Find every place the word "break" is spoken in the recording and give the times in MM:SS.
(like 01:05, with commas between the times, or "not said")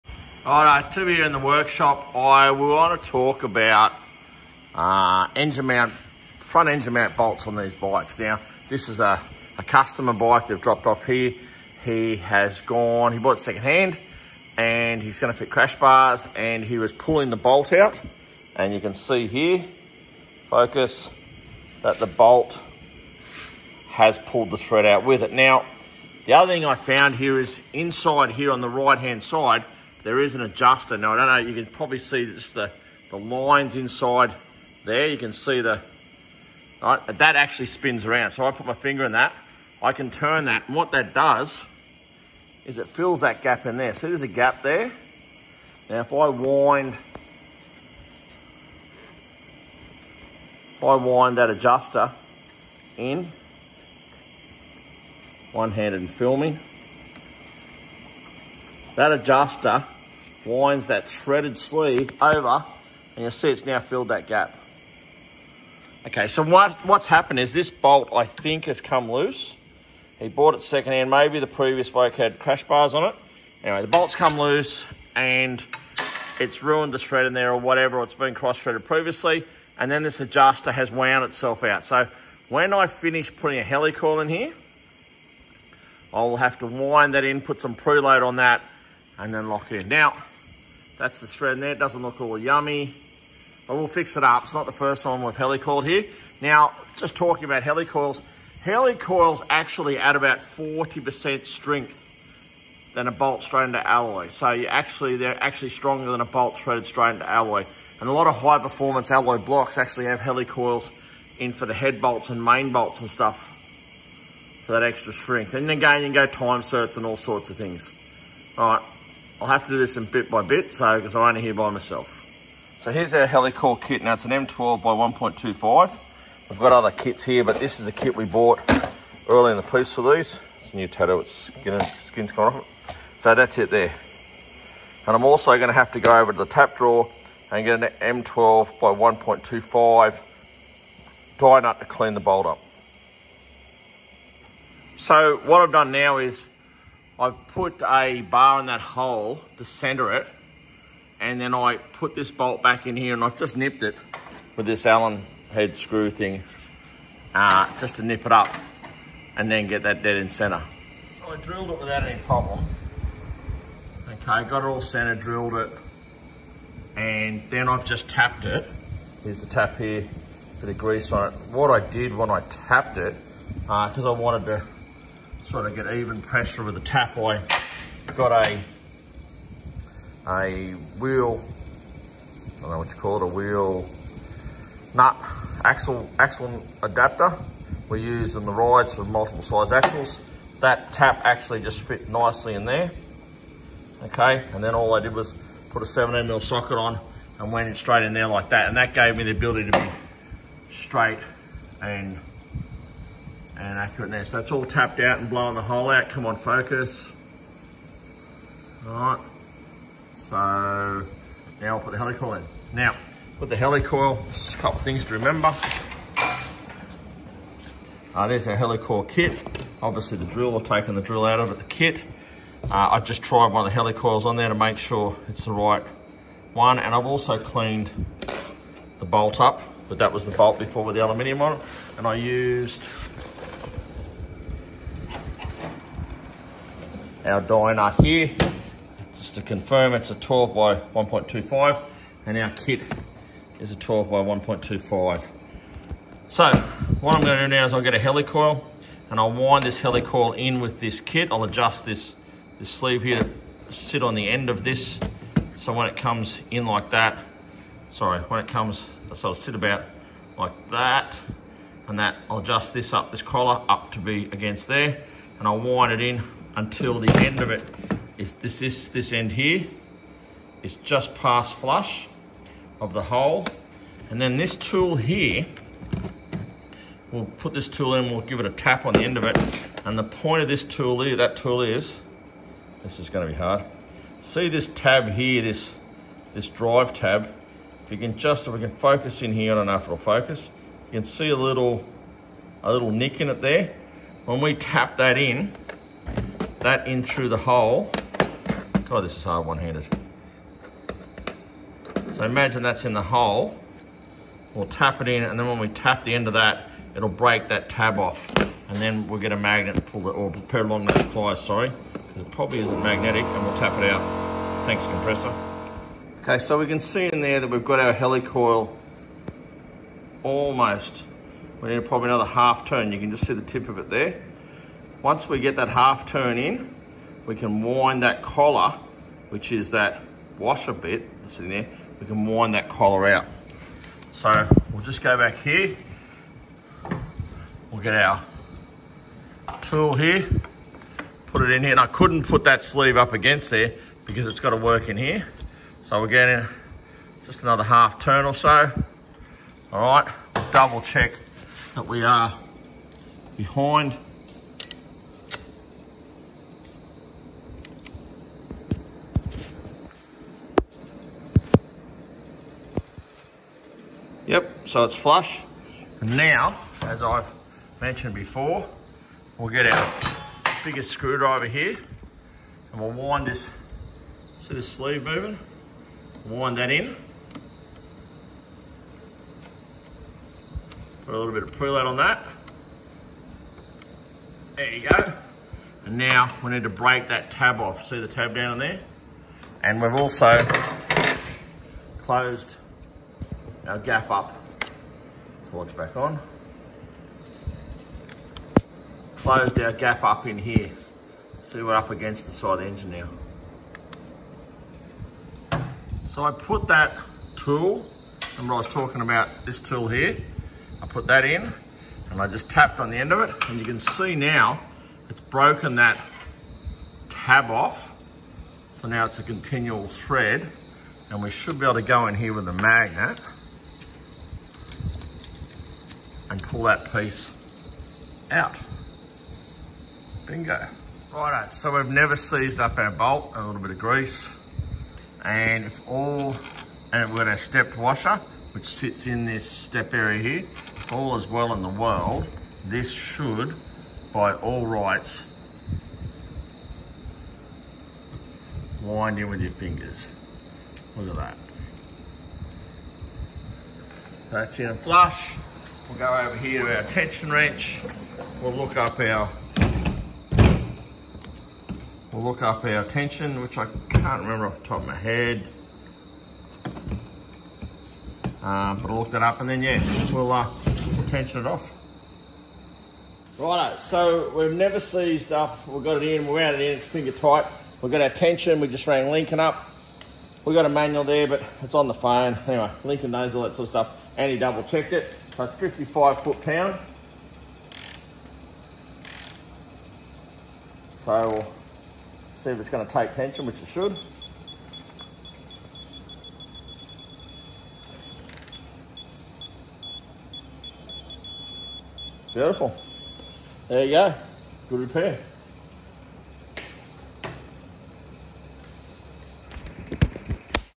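05:07, 06:26.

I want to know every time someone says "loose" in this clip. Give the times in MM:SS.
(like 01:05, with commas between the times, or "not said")
01:09, 01:14.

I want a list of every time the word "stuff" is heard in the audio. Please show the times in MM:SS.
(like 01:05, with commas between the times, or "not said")
01:53, 08:03.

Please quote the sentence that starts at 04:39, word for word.
And the point of this tool, here, that tool is, this is gonna be hard.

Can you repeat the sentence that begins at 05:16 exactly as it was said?
Okay, so we can see in there that we've got our helicoil almost.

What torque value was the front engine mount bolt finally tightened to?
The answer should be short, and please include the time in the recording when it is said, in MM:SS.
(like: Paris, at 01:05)
55 ft-lb, at 08:05.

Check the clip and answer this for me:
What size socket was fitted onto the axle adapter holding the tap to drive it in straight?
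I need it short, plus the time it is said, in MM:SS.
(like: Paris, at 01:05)
17 mm, at 03:15.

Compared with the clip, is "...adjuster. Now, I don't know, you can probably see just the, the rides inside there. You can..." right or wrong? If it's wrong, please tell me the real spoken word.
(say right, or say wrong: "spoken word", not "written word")
wrong: "lines", not "rides".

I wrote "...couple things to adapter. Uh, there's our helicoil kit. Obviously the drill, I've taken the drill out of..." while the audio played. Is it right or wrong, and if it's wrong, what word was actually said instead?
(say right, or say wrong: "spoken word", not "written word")
wrong: "remember", not "adapter".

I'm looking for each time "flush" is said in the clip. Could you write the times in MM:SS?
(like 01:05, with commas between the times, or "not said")
04:31, 06:04, 07:34.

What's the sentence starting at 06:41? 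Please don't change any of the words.
See, we're up against the side engine now.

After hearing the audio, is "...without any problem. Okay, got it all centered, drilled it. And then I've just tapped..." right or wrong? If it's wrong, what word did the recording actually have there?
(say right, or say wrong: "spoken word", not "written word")
right.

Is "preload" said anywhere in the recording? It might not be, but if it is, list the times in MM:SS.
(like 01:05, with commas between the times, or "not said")
01:27, 06:21.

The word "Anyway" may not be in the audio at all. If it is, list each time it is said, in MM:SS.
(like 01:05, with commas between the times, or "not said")
01:13, 08:02.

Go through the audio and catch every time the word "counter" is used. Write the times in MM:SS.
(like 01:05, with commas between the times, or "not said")
not said.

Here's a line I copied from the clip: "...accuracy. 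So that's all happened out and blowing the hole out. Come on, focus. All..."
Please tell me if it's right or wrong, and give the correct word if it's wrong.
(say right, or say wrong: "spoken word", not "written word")
wrong: "tapped", not "happened".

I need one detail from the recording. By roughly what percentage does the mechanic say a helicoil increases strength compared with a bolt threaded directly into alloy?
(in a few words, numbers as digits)
40%.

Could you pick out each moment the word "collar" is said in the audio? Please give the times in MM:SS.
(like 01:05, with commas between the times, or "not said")
04:23, 05:28, 05:32.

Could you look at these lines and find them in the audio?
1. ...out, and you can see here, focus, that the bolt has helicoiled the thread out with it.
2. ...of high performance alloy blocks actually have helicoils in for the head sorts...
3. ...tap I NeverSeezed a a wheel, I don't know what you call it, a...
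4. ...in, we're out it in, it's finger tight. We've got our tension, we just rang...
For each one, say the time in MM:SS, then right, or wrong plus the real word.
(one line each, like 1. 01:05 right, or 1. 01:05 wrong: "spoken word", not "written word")
1. 00:17 wrong: "pulled", not "helicoiled"
2. 01:48 wrong: "bolts", not "sorts"
3. 02:56 wrong: "Got", not "NeverSeezed"
4. 07:56 right.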